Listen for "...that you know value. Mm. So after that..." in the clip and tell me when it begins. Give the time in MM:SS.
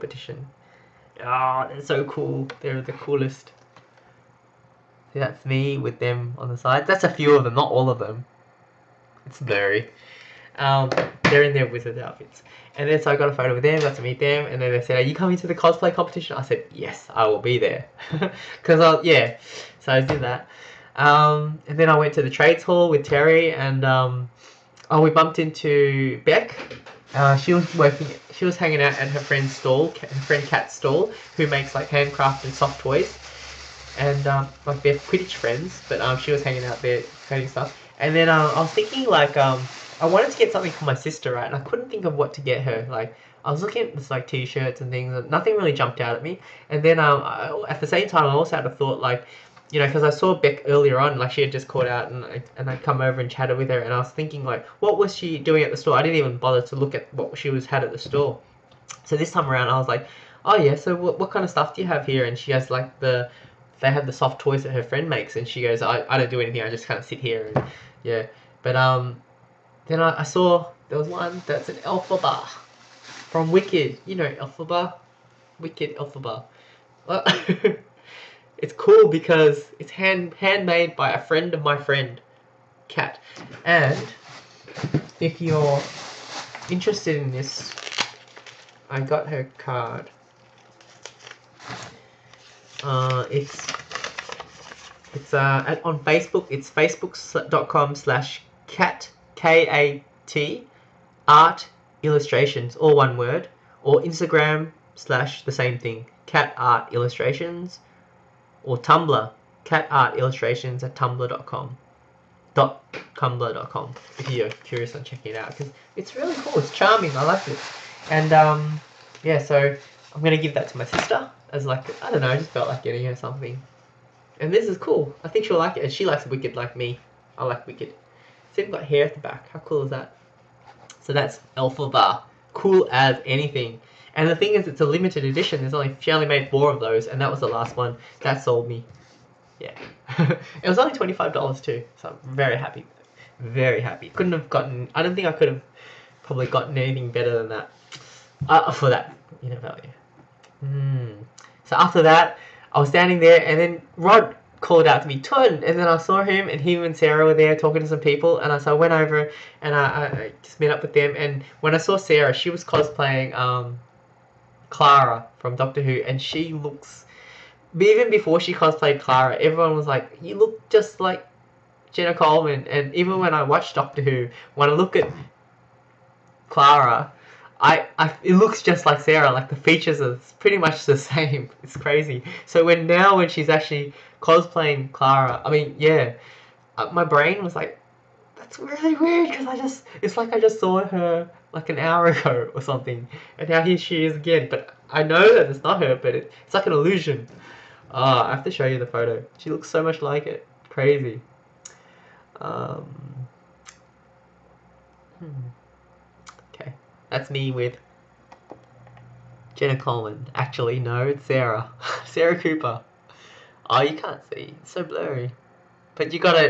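02:28.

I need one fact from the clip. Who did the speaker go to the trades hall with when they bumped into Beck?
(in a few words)
Terry.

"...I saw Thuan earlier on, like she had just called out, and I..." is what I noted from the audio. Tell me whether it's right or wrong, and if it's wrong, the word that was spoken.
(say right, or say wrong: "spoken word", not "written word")
wrong: "Beck", not "Thuan".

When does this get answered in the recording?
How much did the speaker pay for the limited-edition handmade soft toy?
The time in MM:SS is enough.
02:20.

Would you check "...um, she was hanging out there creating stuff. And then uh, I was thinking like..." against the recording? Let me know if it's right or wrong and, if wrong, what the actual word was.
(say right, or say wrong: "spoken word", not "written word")
right.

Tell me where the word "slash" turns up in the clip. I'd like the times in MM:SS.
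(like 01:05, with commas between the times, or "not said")
01:37, 01:44.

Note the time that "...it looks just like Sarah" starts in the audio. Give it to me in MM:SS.
02:58.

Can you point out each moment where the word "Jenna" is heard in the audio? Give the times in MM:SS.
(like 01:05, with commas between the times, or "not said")
02:51, 03:29.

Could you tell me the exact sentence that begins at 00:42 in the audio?
Like I was looking at this like t-shirts and things, and nothing really jumped out at me.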